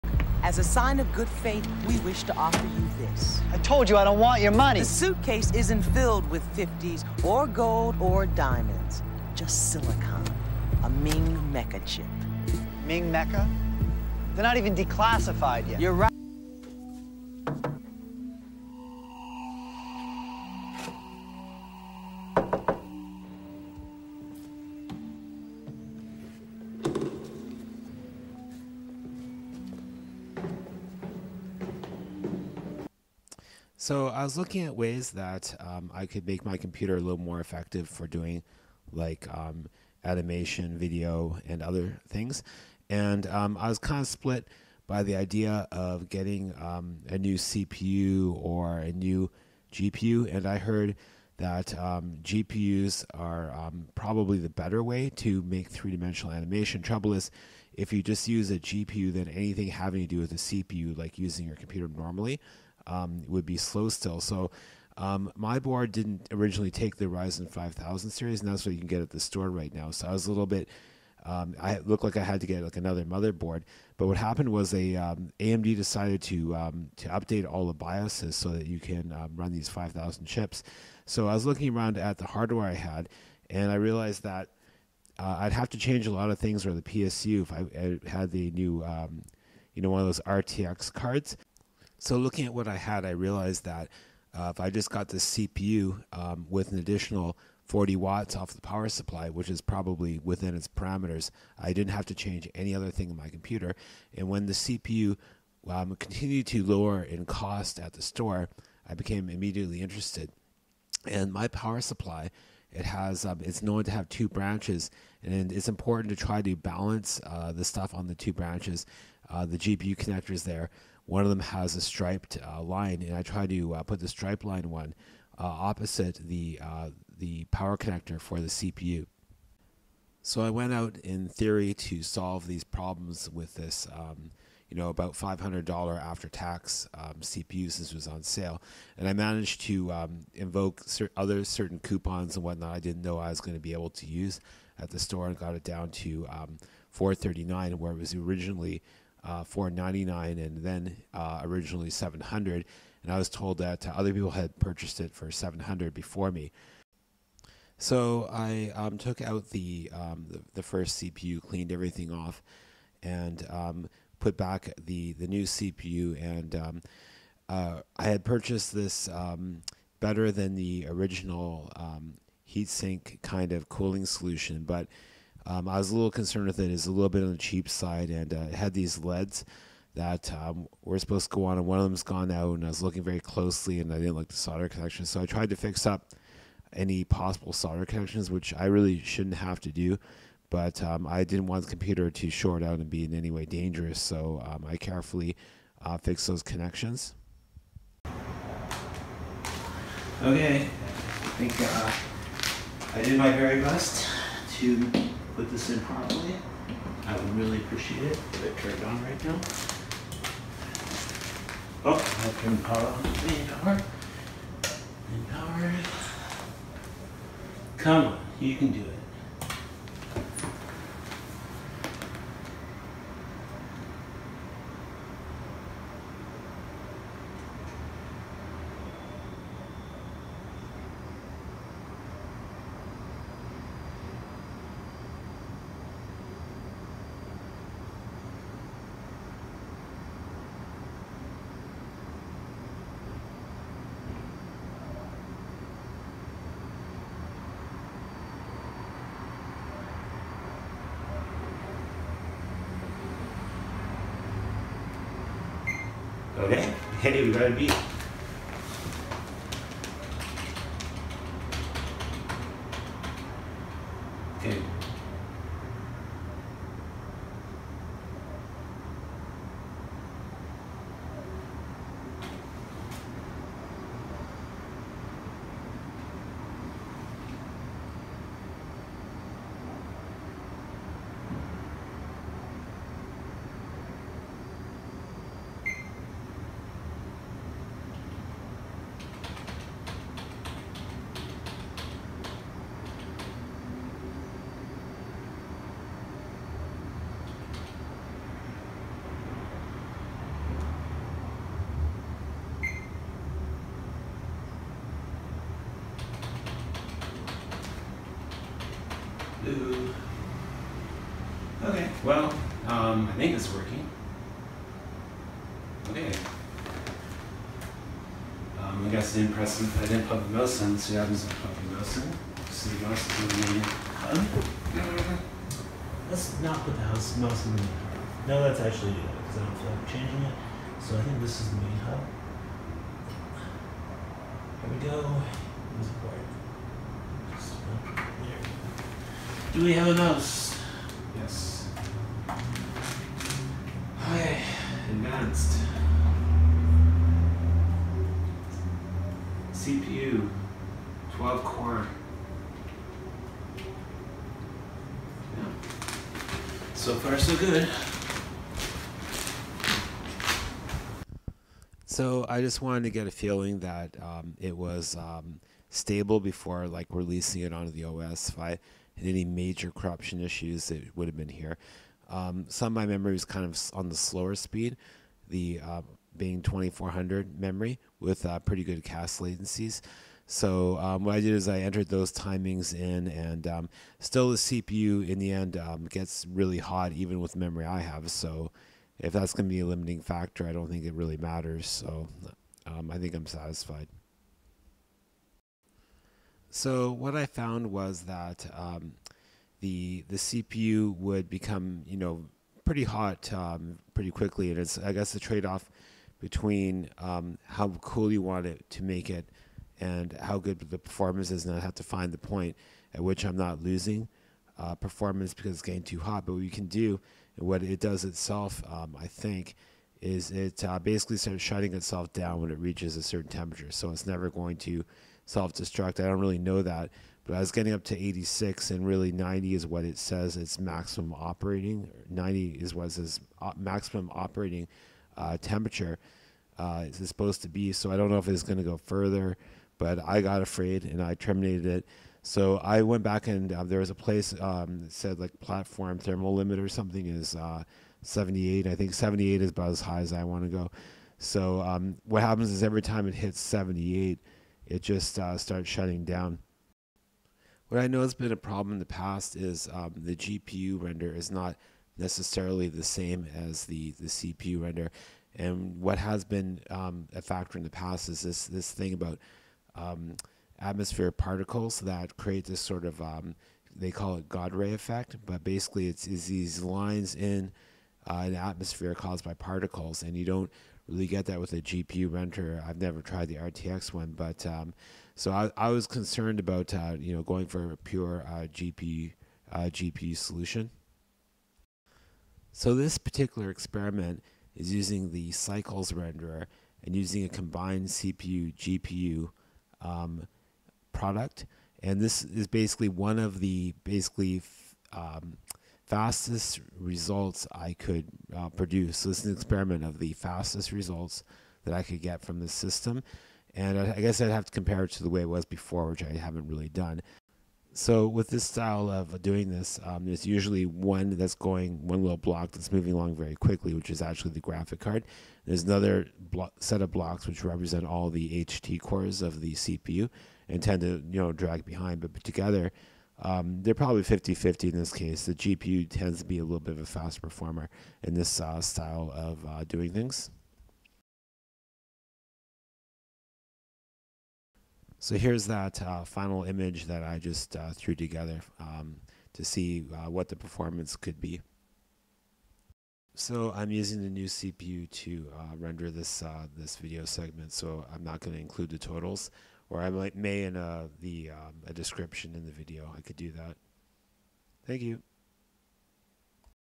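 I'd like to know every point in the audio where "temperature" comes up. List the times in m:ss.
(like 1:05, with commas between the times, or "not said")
7:03, 7:15.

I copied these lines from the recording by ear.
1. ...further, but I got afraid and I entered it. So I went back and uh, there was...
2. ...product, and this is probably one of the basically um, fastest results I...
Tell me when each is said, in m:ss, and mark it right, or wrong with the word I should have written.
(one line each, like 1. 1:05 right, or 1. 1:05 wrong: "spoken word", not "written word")
1. 7:18 wrong: "terminated", not "entered"
2. 8:20 wrong: "basically", not "probably".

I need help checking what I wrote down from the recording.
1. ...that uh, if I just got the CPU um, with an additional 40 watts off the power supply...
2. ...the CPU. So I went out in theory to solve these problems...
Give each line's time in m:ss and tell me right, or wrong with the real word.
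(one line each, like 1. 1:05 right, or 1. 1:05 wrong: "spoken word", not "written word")
1. 1:33 right
2. 2:08 right.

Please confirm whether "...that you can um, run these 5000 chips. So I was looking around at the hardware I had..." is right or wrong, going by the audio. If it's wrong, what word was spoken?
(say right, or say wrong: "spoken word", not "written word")
right.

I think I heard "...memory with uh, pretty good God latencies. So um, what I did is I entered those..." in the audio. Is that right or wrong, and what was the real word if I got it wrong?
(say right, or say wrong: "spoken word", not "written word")
wrong: "CAS", not "God".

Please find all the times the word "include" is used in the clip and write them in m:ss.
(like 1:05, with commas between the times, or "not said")
9:18.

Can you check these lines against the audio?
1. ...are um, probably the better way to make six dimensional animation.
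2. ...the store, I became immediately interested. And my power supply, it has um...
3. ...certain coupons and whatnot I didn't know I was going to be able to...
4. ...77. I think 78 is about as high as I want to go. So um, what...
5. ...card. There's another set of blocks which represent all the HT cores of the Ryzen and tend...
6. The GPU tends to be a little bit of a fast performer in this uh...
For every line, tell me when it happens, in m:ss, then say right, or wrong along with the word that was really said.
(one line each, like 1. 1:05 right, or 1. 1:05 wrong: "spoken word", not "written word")
1. 0:53 wrong: "three", not "six"
2. 1:47 right
3. 2:21 right
4. 7:28 wrong: "78", not "77"
5. 8:44 wrong: "CPU", not "Ryzen"
6. 8:55 right.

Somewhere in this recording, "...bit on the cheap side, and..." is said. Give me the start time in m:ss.
2:57.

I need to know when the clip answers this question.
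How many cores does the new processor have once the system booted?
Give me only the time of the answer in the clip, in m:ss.
5:51.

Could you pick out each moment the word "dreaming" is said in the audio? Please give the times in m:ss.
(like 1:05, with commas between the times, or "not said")
not said.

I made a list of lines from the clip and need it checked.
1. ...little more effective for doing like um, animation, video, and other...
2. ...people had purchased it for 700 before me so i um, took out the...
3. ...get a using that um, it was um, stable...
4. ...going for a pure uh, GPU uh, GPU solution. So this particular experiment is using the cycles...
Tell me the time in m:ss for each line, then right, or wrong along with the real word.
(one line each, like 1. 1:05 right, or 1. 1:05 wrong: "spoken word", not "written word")
1. 0:36 right
2. 2:34 right
3. 6:02 wrong: "feeling", not "using"
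4. 8:07 right.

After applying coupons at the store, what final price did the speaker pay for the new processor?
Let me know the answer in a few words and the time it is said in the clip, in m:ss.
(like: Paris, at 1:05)
439, at 2:26.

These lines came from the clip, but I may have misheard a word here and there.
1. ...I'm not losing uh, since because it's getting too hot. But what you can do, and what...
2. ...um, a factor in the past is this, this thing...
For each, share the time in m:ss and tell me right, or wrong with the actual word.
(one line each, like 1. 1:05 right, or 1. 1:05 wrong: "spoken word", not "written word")
1. 6:53 wrong: "performance", not "since"
2. 7:46 right.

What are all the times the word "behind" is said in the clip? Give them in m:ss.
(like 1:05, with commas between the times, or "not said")
8:51.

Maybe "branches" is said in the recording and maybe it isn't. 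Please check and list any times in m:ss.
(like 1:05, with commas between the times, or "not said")
1:54, 1:58.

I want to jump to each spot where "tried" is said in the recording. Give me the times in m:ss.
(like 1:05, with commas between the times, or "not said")
3:05, 8:03.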